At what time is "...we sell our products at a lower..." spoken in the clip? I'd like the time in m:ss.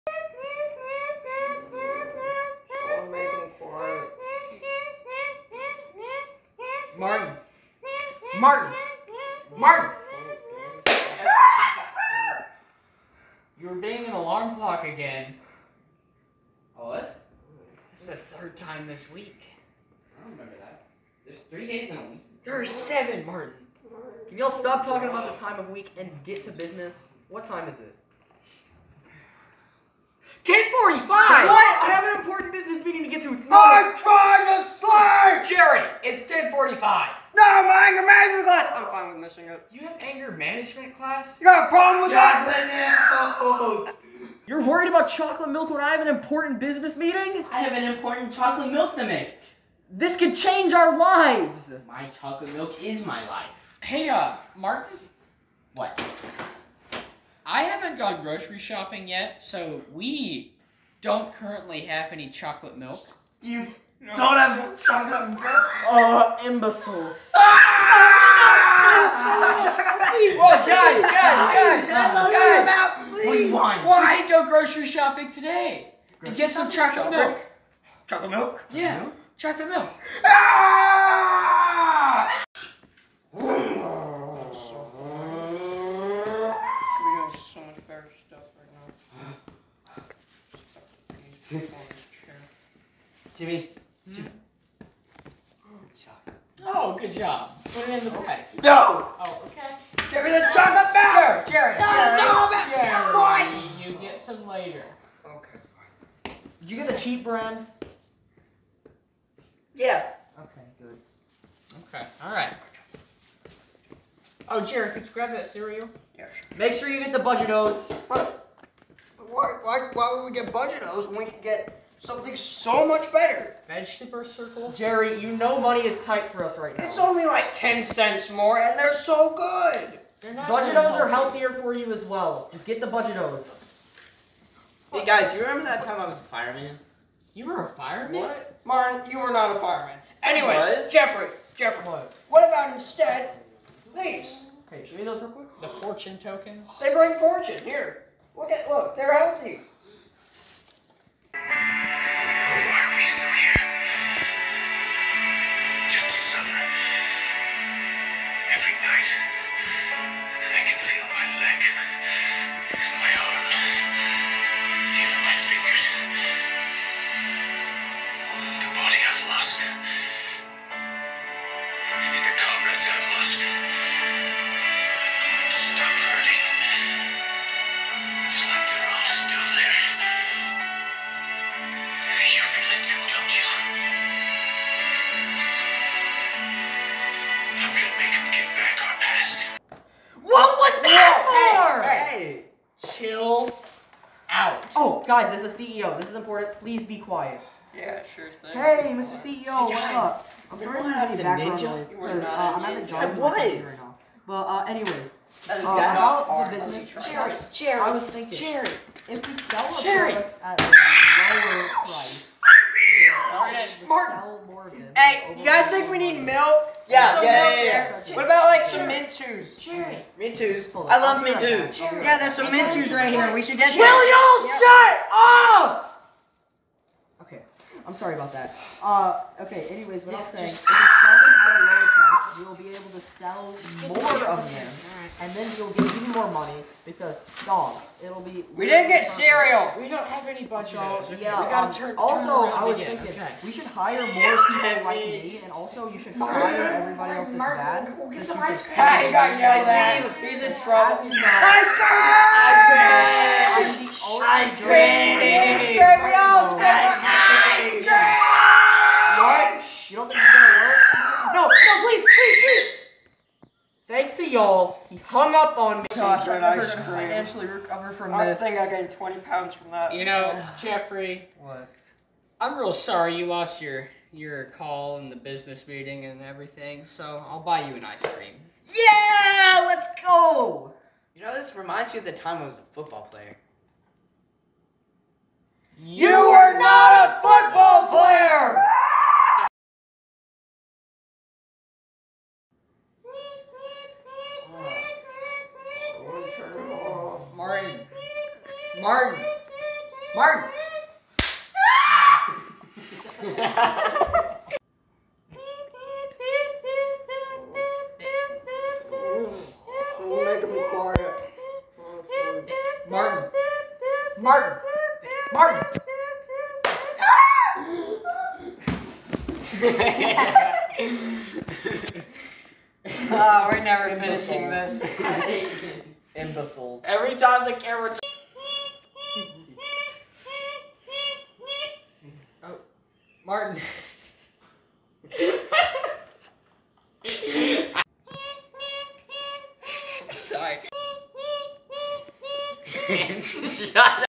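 3:29.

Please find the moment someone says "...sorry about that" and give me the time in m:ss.
3:47.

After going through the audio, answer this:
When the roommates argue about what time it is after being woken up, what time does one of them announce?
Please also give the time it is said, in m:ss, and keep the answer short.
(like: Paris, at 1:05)
10:45, at 0:30.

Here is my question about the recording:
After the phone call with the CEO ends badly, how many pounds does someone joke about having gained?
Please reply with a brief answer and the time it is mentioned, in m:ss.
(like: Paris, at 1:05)
20 pounds, at 4:28.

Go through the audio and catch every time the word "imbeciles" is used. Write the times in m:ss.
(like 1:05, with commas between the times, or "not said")
1:06, 5:26.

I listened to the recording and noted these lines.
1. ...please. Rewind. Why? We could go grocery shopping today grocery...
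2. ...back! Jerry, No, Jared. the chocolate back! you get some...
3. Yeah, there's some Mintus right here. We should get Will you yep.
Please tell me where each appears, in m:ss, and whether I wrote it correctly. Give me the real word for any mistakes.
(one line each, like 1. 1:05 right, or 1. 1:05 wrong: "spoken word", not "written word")
1. 1:13 right
2. 1:40 right
3. 3:41 right.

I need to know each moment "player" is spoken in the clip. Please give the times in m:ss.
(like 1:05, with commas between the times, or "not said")
4:43, 4:47.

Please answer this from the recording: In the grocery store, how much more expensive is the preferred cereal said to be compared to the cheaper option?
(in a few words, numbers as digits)
10 cents.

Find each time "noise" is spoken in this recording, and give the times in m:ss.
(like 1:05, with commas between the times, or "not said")
3:21.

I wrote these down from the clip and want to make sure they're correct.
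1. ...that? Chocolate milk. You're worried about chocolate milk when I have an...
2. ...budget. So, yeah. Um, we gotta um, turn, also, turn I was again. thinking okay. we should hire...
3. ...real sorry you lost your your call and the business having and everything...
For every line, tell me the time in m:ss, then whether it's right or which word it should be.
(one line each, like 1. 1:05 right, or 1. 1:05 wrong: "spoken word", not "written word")
1. 0:42 right
2. 4:00 right
3. 4:32 wrong: "meeting", not "having".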